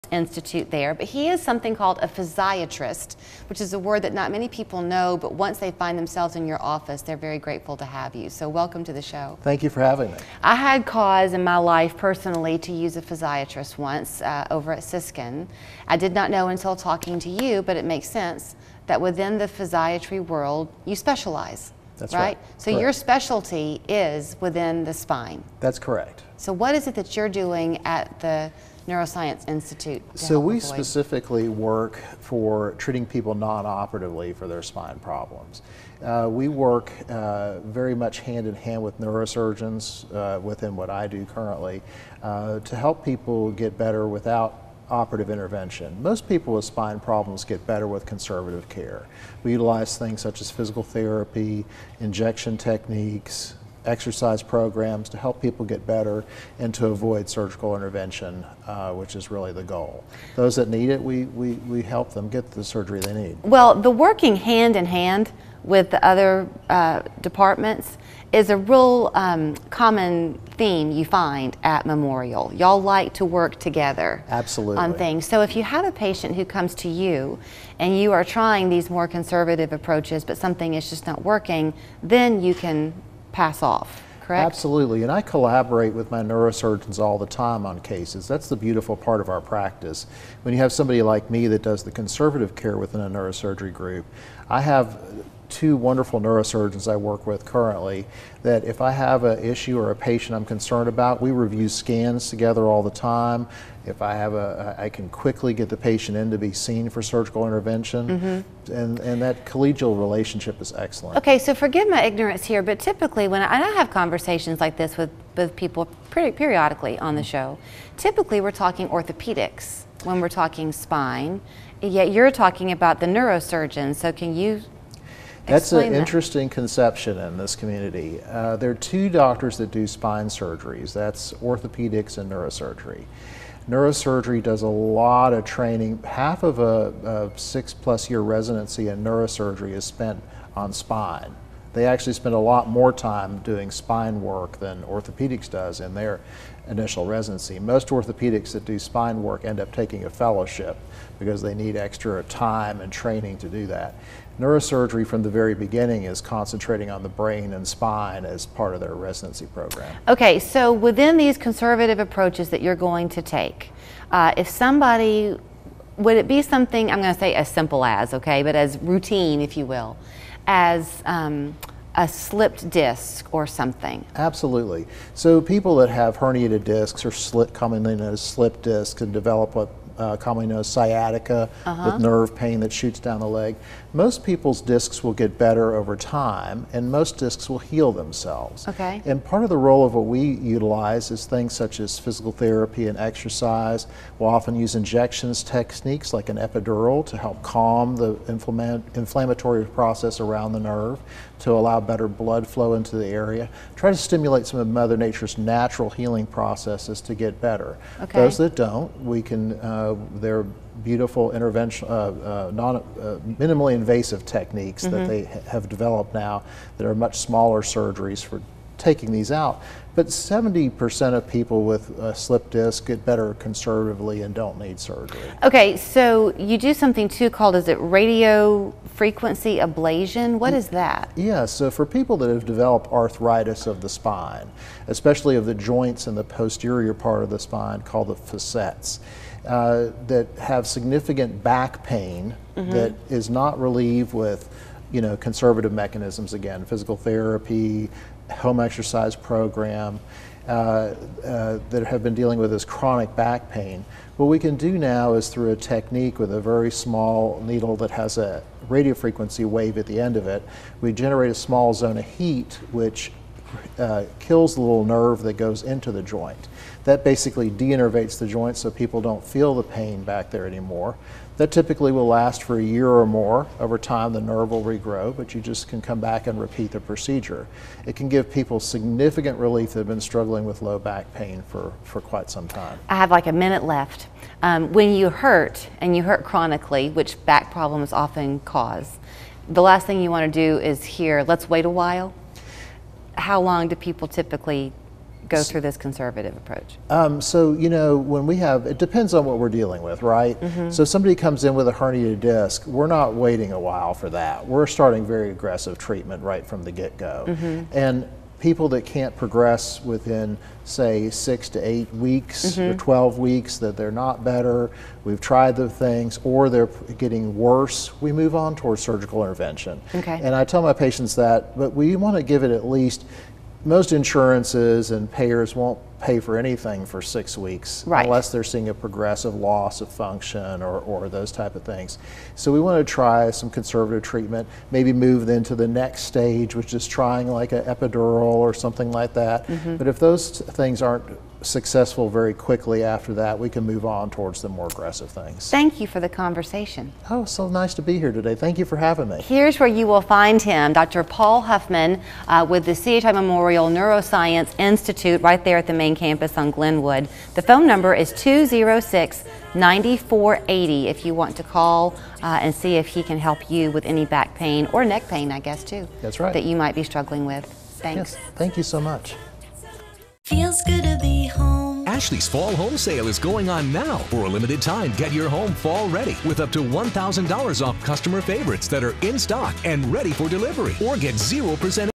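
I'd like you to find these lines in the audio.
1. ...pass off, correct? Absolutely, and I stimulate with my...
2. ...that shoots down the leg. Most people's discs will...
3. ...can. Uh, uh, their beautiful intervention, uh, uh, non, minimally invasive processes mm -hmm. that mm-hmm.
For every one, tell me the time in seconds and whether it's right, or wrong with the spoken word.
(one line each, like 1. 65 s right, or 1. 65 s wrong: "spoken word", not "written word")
1. 83 s wrong: "collaborate", not "stimulate"
2. 182 s right
3. 209 s wrong: "techniques", not "processes".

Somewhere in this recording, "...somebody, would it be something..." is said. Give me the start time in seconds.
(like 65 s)
164 s.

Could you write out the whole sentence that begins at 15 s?
I did not know until talking to you, but it makes sense that within the physiatry world, you specialize.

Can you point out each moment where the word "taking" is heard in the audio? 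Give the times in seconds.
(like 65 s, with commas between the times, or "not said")
149 s, 218 s.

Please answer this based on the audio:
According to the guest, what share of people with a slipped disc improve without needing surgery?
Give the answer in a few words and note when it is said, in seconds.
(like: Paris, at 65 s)
70%, at 220 s.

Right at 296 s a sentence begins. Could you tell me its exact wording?
Um, so, you know, when we have, it depends on what we're dealing with, right?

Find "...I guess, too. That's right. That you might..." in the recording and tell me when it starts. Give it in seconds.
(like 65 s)
365 s.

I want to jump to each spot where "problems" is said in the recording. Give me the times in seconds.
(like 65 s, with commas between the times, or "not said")
34 s, 46 s, 287 s.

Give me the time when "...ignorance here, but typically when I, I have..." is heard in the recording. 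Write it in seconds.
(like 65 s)
112 s.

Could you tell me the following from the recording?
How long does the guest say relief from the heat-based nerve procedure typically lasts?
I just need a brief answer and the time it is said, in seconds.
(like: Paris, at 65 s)
A year or more, at 272 s.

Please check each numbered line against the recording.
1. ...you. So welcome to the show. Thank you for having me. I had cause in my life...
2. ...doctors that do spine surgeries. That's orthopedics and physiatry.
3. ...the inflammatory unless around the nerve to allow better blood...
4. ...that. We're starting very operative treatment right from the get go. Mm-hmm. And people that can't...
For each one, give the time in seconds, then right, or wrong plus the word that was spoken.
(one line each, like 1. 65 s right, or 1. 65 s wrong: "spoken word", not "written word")
1. 8 s right
2. 129 s wrong: "neurosurgery", not "physiatry"
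3. 197 s wrong: "process", not "unless"
4. 304 s wrong: "aggressive", not "operative".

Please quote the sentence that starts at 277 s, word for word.
It can give people significant relief that have been struggling with low back pain for, for quite some time.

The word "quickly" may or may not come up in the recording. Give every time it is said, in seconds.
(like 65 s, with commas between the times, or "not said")
105 s, 342 s.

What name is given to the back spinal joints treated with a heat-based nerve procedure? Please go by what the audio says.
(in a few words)
Facets.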